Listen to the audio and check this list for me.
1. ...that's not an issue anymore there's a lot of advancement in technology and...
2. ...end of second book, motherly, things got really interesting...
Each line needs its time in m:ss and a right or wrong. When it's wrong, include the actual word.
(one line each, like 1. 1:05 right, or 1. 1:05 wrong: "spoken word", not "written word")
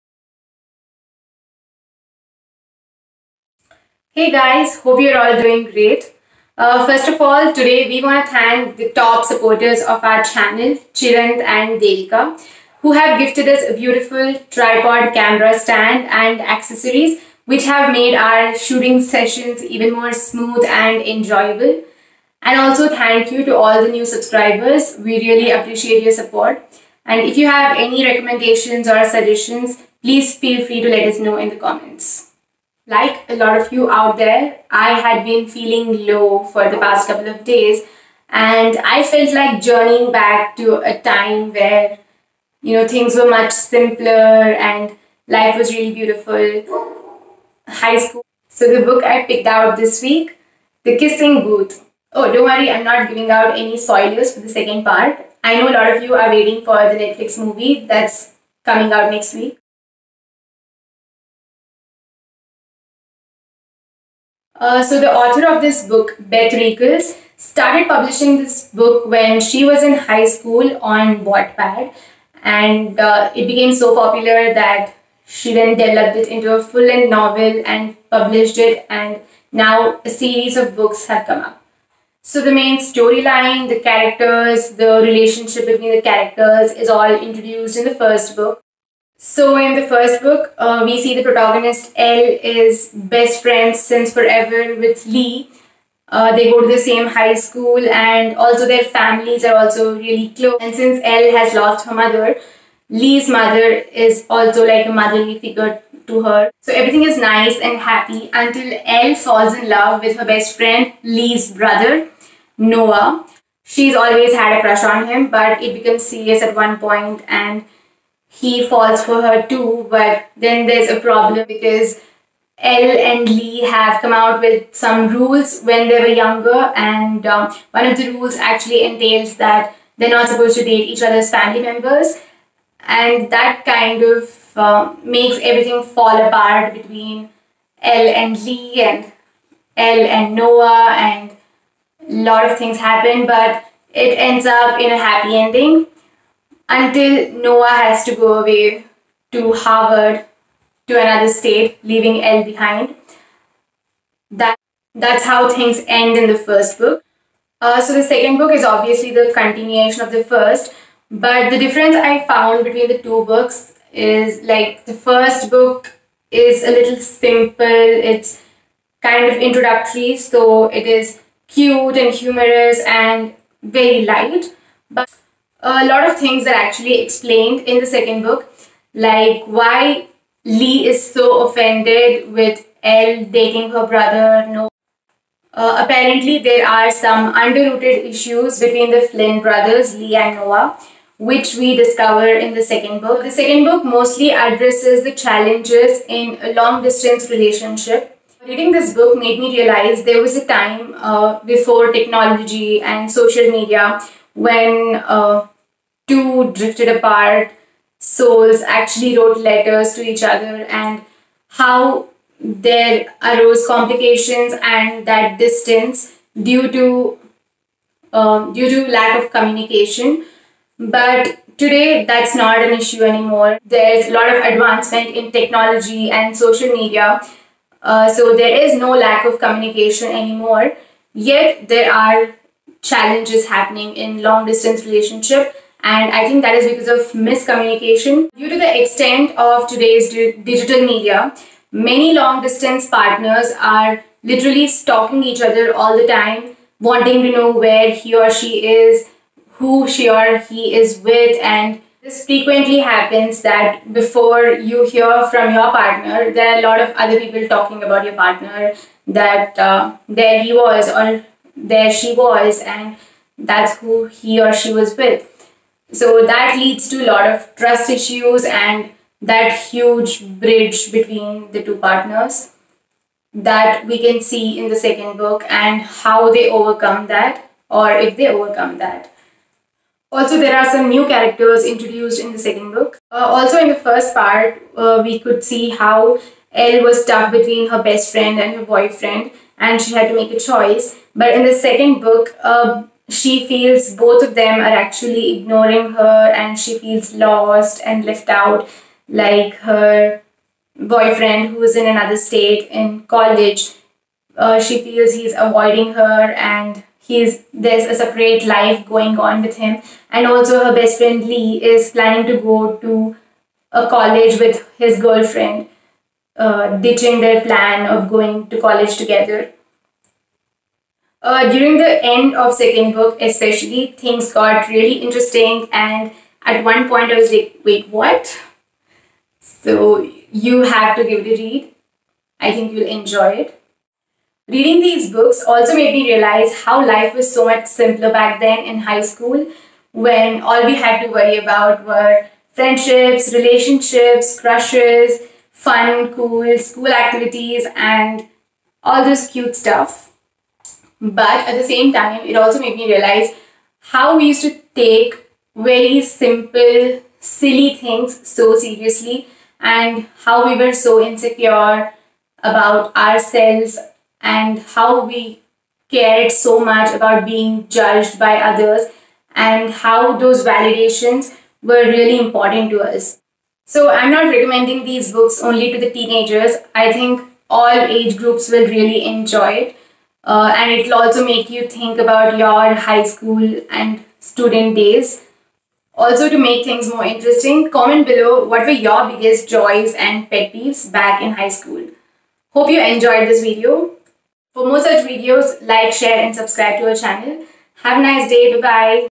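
1. 3:42 right
2. 5:22 wrong: "especially", not "motherly".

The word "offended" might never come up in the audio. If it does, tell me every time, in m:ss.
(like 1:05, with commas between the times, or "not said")
3:01.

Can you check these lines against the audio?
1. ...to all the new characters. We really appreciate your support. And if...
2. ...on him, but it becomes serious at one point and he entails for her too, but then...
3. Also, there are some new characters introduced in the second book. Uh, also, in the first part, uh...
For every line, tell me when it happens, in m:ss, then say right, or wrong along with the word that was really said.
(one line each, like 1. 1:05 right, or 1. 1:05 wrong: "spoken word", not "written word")
1. 0:23 wrong: "subscribers", not "characters"
2. 1:54 wrong: "falls", not "entails"
3. 4:40 right.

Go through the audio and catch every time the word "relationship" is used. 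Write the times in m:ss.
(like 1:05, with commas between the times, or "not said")
1:25, 3:17, 3:54, 5:43.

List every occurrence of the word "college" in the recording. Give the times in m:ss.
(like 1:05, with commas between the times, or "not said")
5:03, 5:13, 5:18.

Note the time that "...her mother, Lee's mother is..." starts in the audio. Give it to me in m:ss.
1:41.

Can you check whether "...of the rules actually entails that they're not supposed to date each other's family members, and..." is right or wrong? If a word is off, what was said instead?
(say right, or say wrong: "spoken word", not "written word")
right.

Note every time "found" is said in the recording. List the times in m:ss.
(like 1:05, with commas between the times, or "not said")
2:42.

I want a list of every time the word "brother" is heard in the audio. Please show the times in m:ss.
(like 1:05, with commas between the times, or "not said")
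1:51, 3:03, 3:09.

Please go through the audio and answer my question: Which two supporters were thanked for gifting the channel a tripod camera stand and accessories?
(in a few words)
Chiranth and Devika.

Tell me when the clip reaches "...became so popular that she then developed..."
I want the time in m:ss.
1:13.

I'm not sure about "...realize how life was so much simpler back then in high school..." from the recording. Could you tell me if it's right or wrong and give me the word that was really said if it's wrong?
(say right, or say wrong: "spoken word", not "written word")
right.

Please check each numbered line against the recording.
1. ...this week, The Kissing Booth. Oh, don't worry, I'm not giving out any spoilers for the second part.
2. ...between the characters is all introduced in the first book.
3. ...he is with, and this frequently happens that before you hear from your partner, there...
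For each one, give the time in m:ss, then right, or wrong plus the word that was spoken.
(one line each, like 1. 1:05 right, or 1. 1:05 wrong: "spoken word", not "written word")
1. 0:49 right
2. 1:25 right
3. 4:10 right.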